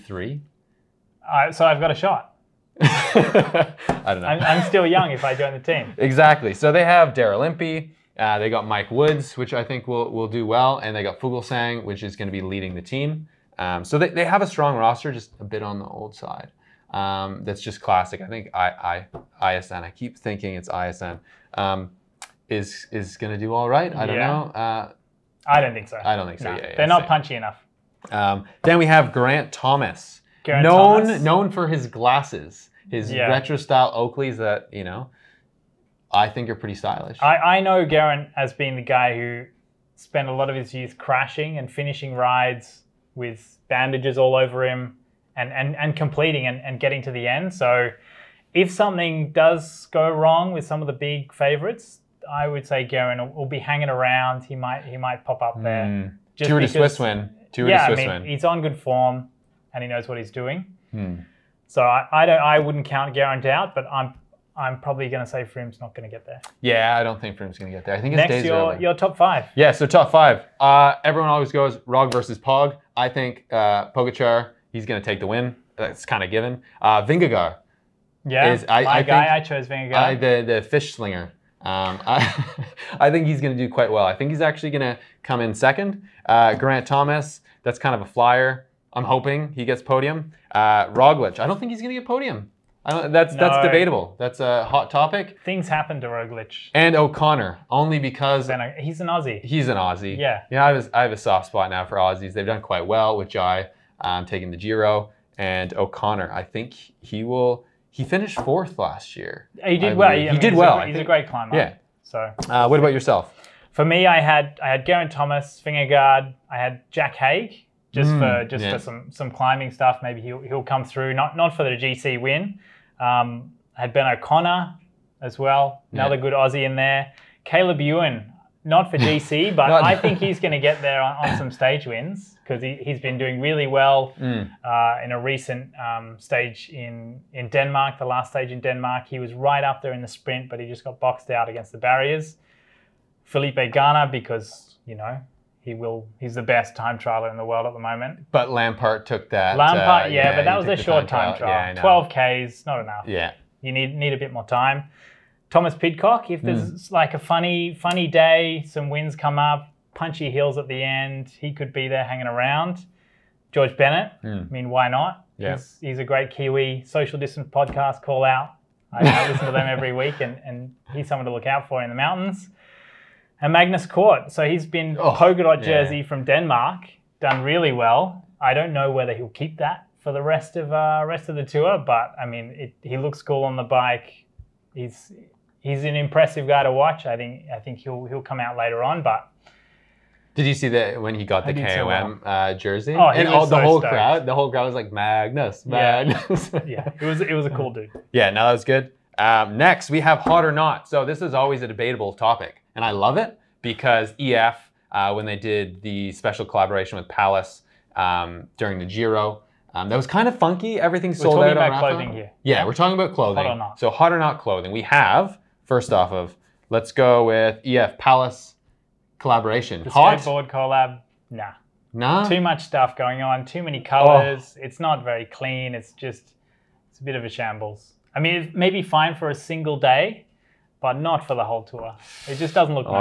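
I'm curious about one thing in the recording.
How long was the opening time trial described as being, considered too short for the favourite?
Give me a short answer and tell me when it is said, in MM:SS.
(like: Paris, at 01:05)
12 km, at 02:31.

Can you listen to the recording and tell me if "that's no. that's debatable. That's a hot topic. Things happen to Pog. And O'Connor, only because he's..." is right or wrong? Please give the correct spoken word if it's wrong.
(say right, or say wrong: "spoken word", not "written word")
wrong: "Roglic", not "Pog".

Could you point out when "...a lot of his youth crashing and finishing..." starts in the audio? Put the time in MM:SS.
00:40.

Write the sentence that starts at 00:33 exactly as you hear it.
retro style Oakleys that you know, I think are pretty stylish.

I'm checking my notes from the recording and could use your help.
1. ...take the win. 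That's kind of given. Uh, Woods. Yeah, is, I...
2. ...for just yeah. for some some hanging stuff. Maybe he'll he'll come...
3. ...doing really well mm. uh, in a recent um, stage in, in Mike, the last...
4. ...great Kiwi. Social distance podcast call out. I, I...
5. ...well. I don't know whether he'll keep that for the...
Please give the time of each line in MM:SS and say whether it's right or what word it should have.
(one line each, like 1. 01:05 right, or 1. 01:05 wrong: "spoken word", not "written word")
1. 01:15 wrong: "Vingegaard", not "Woods"
2. 01:58 wrong: "climbing", not "hanging"
3. 02:13 wrong: "Denmark", not "Mike"
4. 02:46 right
5. 02:57 right.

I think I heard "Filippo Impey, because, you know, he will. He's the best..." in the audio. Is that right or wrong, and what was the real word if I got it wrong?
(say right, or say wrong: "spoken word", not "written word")
wrong: "Ganna", not "Impey".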